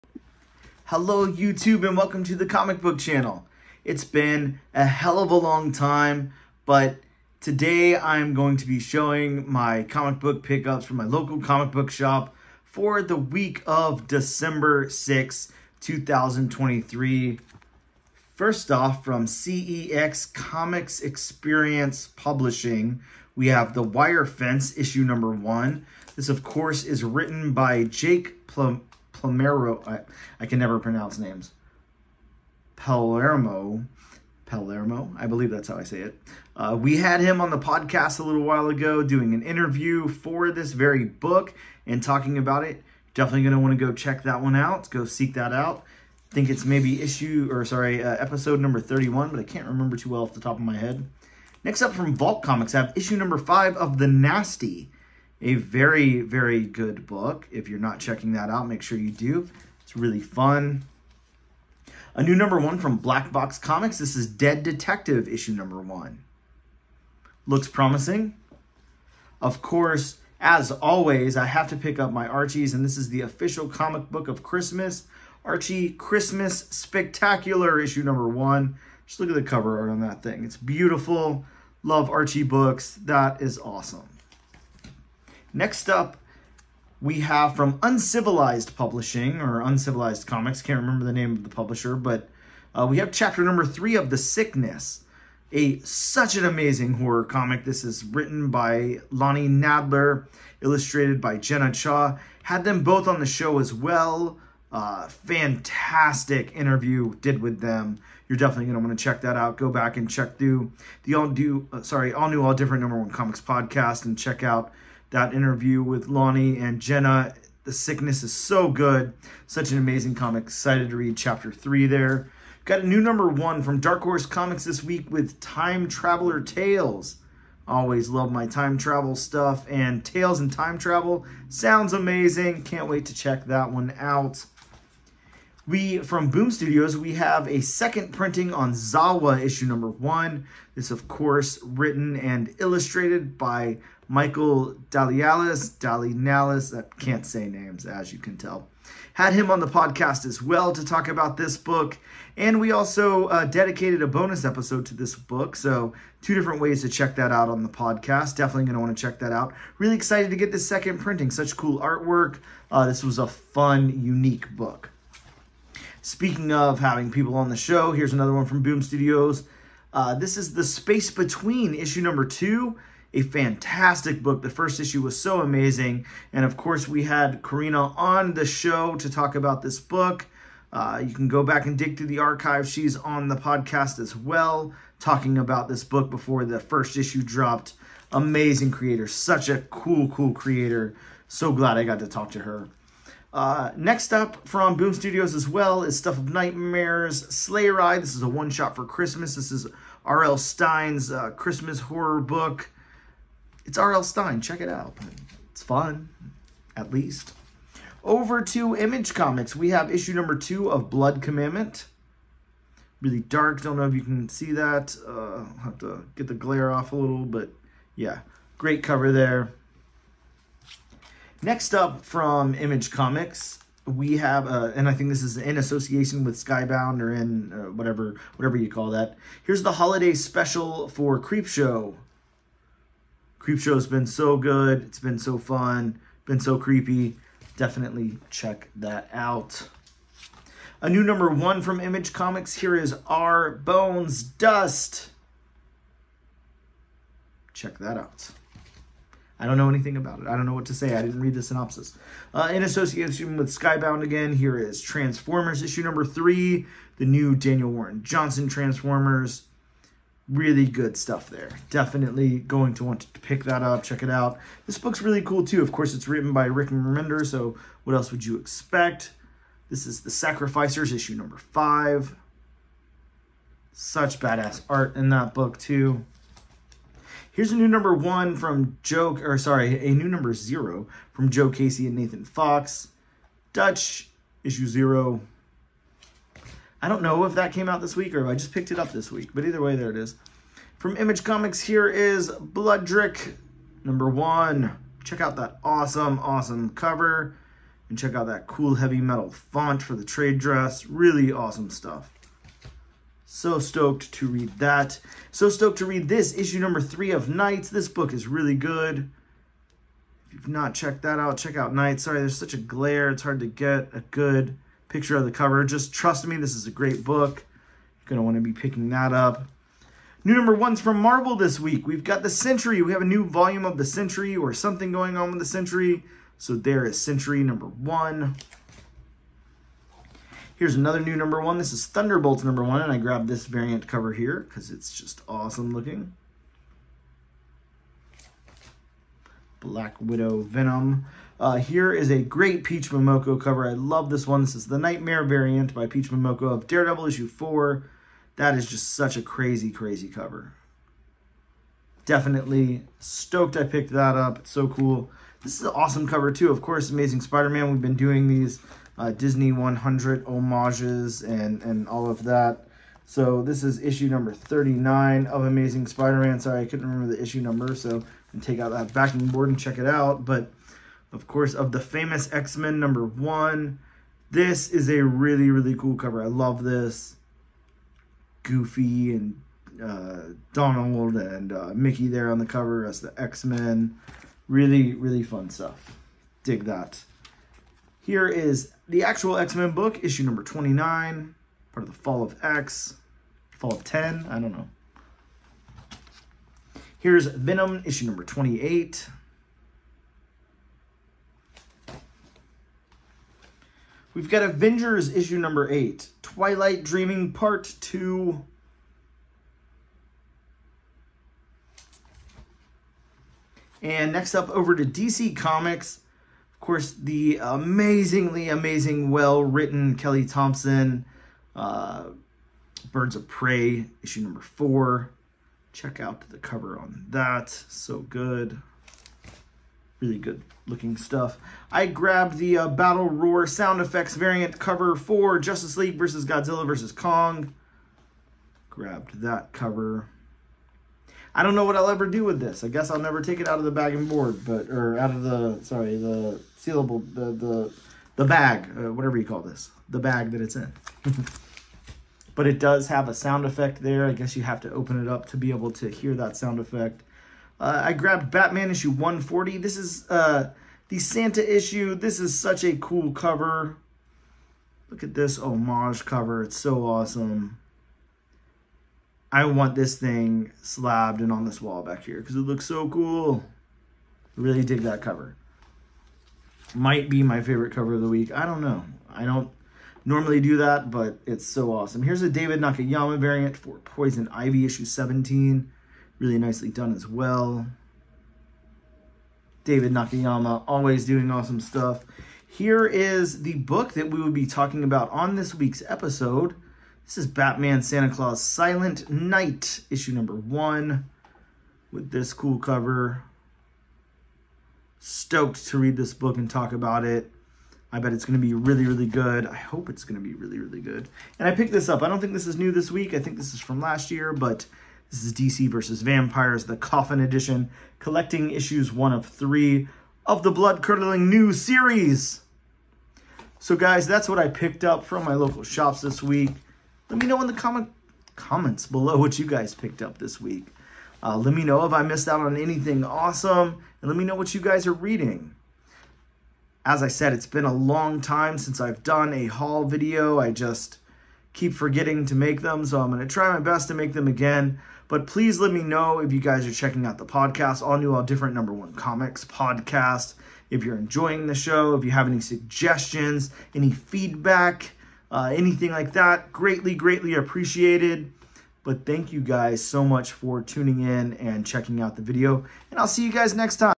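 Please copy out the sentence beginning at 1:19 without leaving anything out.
Just look at the cover art on that thing.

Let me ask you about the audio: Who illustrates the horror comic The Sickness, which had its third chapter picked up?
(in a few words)
Jenna Cha.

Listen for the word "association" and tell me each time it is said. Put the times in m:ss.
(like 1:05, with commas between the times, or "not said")
3:45, 4:12.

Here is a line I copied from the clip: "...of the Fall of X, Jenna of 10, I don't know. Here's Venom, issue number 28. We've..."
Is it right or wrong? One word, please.
wrong.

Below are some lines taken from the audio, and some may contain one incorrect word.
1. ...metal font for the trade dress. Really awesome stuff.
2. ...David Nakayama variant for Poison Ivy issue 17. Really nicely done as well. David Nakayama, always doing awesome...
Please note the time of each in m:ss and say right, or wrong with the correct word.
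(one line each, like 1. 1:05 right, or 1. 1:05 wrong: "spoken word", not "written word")
1. 4:58 right
2. 8:02 right.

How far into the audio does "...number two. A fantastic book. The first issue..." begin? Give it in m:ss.
2:52.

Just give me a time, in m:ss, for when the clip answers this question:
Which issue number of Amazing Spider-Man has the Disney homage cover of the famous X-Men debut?
6:04.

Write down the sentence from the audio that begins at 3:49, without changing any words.
Here's the holiday special for Creepshow.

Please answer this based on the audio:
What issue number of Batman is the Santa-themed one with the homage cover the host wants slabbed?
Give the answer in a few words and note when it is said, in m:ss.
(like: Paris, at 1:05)
140, at 7:38.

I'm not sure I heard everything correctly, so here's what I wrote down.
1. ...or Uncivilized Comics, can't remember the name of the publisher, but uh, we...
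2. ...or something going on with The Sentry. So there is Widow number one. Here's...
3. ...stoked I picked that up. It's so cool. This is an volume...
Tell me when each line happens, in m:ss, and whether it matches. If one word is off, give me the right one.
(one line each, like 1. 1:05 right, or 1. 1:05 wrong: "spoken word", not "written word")
1. 1:29 right
2. 5:24 wrong: "Sentry", not "Widow"
3. 5:52 wrong: "awesome", not "volume".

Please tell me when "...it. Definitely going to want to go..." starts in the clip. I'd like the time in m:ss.
0:42.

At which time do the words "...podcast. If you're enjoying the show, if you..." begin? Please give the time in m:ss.
9:09.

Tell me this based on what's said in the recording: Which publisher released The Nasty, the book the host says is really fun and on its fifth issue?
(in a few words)
Vault Comics.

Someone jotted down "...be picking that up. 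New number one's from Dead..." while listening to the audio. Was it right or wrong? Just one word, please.
wrong.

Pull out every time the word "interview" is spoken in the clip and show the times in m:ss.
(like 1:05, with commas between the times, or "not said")
0:39, 1:46, 1:55.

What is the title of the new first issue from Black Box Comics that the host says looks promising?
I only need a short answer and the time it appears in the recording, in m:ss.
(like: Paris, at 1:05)
Dead Detective, at 1:04.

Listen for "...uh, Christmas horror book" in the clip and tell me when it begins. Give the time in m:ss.
3:21.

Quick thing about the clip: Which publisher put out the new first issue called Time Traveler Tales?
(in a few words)
Dark Horse Comics.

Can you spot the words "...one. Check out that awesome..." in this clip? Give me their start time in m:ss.
4:54.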